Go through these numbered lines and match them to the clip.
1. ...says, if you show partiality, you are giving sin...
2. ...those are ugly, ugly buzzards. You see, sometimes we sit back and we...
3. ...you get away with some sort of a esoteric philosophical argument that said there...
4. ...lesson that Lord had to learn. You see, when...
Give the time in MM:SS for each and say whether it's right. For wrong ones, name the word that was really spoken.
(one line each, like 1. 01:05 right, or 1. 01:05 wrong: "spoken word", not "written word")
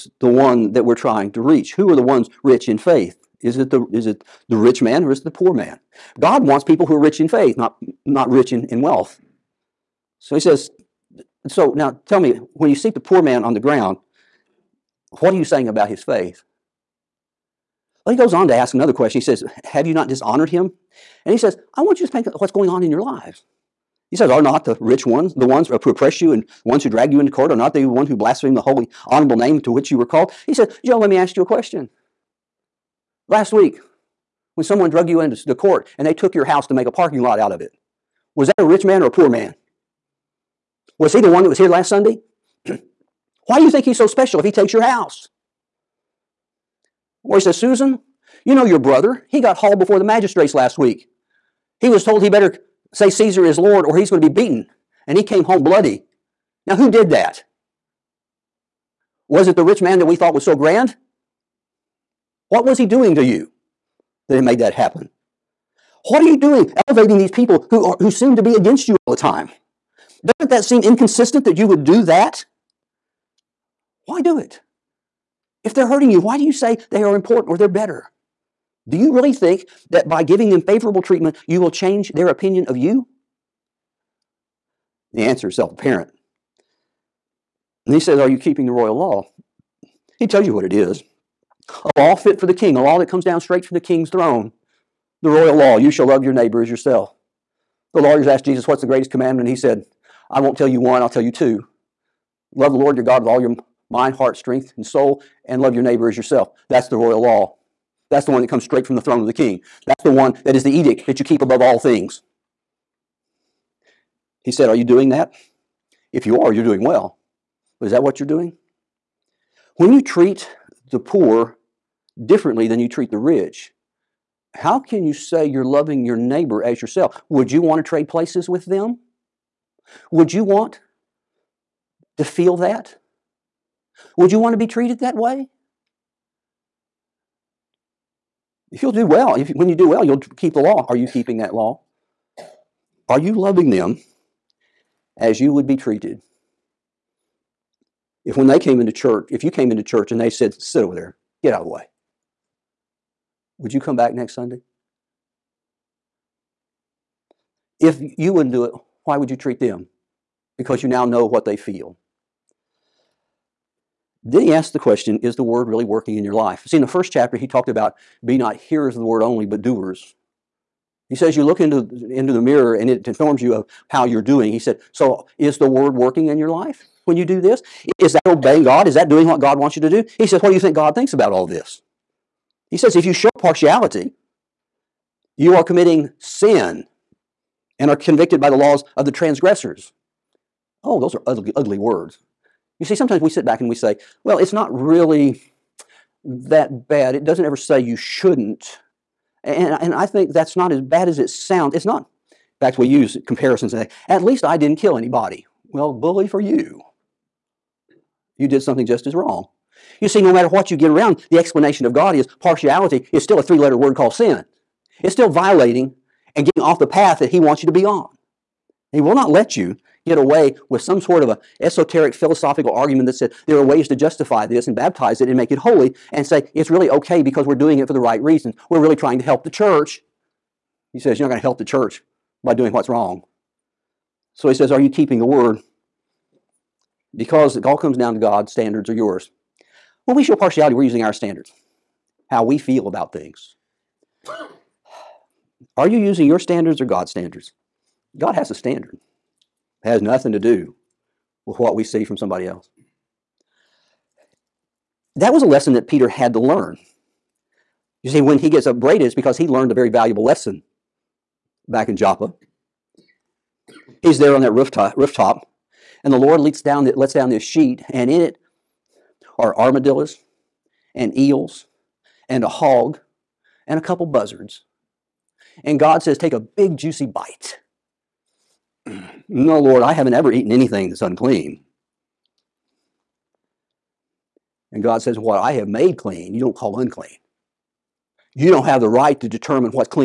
1. 03:02 wrong: "committing", not "giving"
2. 03:10 wrong: "words", not "buzzards"
3. 03:39 right
4. 04:15 wrong: "Peter", not "Lord".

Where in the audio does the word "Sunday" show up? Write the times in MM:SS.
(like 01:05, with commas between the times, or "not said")
00:41, 02:34.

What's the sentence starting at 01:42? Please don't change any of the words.
Love the Lord your God with all your mind, heart, strength, and soul, and love your neighbor as yourself.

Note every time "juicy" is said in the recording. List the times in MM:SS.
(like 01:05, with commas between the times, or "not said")
04:36.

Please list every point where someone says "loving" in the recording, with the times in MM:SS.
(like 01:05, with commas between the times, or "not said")
02:05, 02:23.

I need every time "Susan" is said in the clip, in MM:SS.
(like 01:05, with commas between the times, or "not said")
00:47.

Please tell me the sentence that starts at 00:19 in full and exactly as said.
He says, Have you not dishonored him?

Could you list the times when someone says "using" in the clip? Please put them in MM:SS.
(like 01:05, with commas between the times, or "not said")
04:00, 04:05.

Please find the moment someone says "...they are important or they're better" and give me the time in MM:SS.
01:16.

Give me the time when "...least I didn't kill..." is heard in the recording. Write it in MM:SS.
03:24.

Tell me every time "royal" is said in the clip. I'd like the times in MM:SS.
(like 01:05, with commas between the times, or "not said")
01:28, 01:35, 01:46.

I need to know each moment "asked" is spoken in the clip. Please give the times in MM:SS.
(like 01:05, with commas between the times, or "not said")
01:38, 02:44.